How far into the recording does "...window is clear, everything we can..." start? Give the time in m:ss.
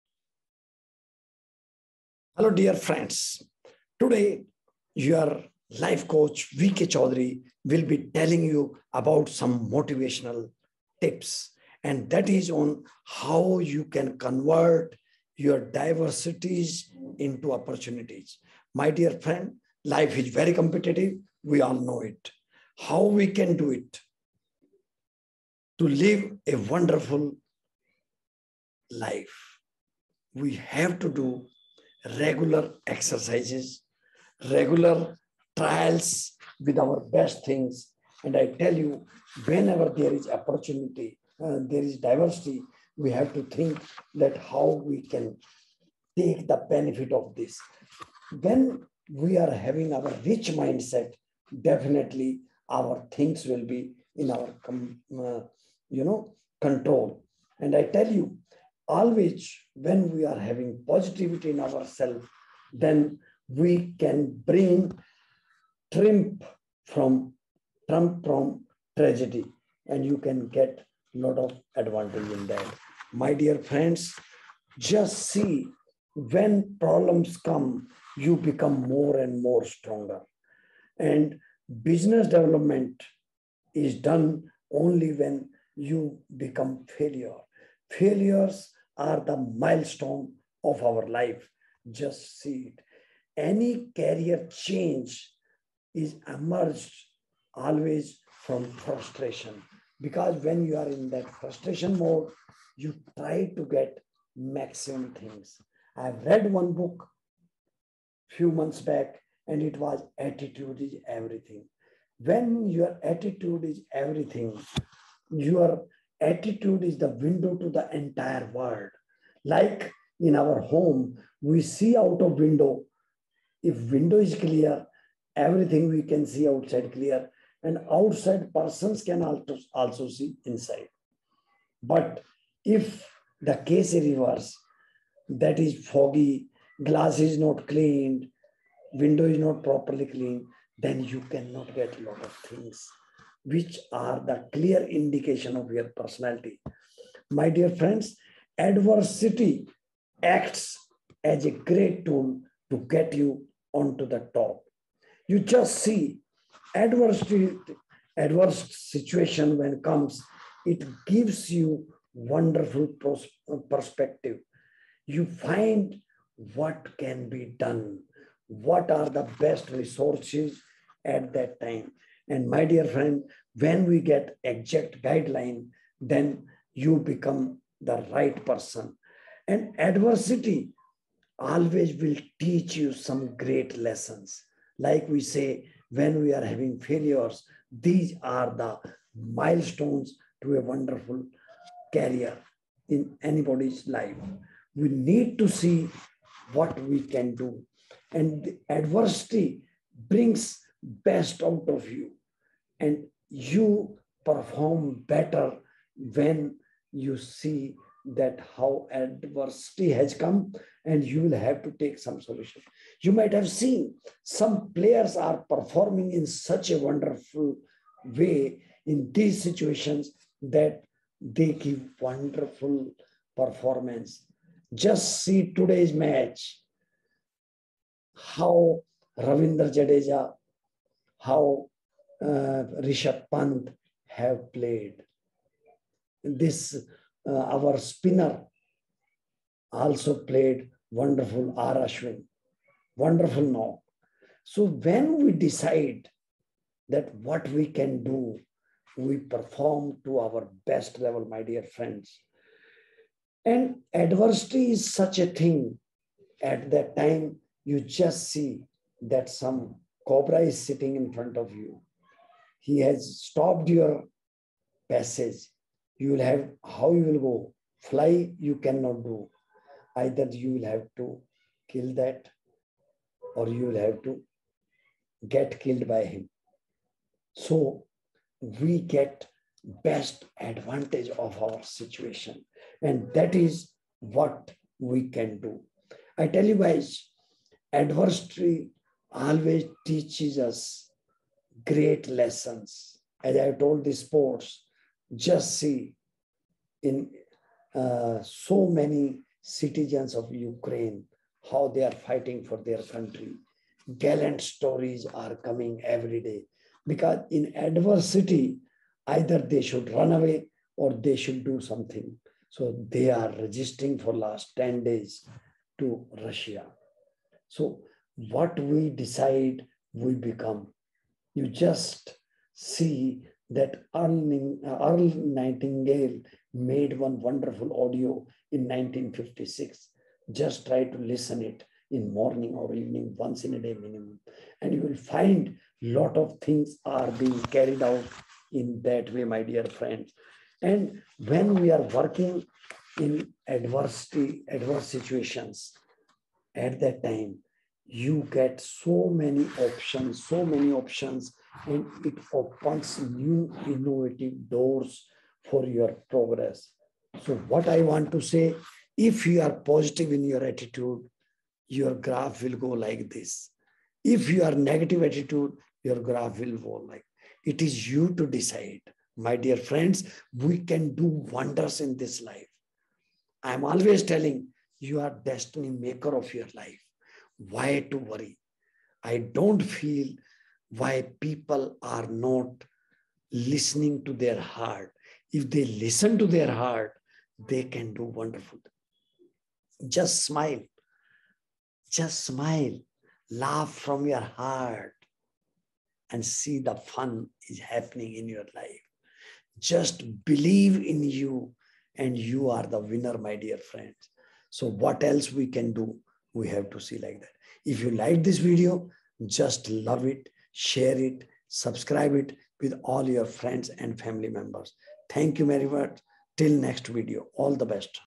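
2:03.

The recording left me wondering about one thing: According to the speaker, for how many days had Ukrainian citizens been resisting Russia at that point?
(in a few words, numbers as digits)
10.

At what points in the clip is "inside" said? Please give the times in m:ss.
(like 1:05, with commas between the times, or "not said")
2:10.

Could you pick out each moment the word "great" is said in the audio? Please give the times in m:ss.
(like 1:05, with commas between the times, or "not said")
2:31, 3:03, 4:51.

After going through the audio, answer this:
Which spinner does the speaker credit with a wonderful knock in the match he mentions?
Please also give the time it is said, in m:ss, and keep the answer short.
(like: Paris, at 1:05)
R. Ashwin, at 4:01.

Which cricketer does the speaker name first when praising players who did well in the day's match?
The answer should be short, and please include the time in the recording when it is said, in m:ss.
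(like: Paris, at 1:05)
Ravindra Jadeja, at 3:49.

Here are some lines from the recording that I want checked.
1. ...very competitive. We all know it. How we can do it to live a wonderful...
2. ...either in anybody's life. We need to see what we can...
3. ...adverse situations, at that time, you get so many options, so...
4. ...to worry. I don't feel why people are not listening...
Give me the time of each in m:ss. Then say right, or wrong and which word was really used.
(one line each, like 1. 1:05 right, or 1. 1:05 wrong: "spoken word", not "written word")
1. 0:20 right
2. 3:11 wrong: "career", not "either"
3. 5:44 right
4. 6:17 right.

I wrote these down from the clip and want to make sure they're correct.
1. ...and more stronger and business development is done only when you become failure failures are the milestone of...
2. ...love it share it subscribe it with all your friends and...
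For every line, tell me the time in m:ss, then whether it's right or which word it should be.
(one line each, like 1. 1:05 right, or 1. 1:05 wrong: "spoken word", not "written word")
1. 1:19 right
2. 6:49 right.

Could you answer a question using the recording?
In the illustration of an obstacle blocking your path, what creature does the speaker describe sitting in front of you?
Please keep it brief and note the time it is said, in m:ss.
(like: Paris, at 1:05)
Cobra, at 4:20.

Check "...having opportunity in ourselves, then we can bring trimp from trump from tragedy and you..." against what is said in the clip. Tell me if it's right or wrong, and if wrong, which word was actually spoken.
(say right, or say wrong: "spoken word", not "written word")
wrong: "positivity", not "opportunity".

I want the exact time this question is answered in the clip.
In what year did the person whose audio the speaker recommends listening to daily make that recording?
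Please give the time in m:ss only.
5:28.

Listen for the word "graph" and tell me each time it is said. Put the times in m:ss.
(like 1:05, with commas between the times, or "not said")
6:01, 6:06.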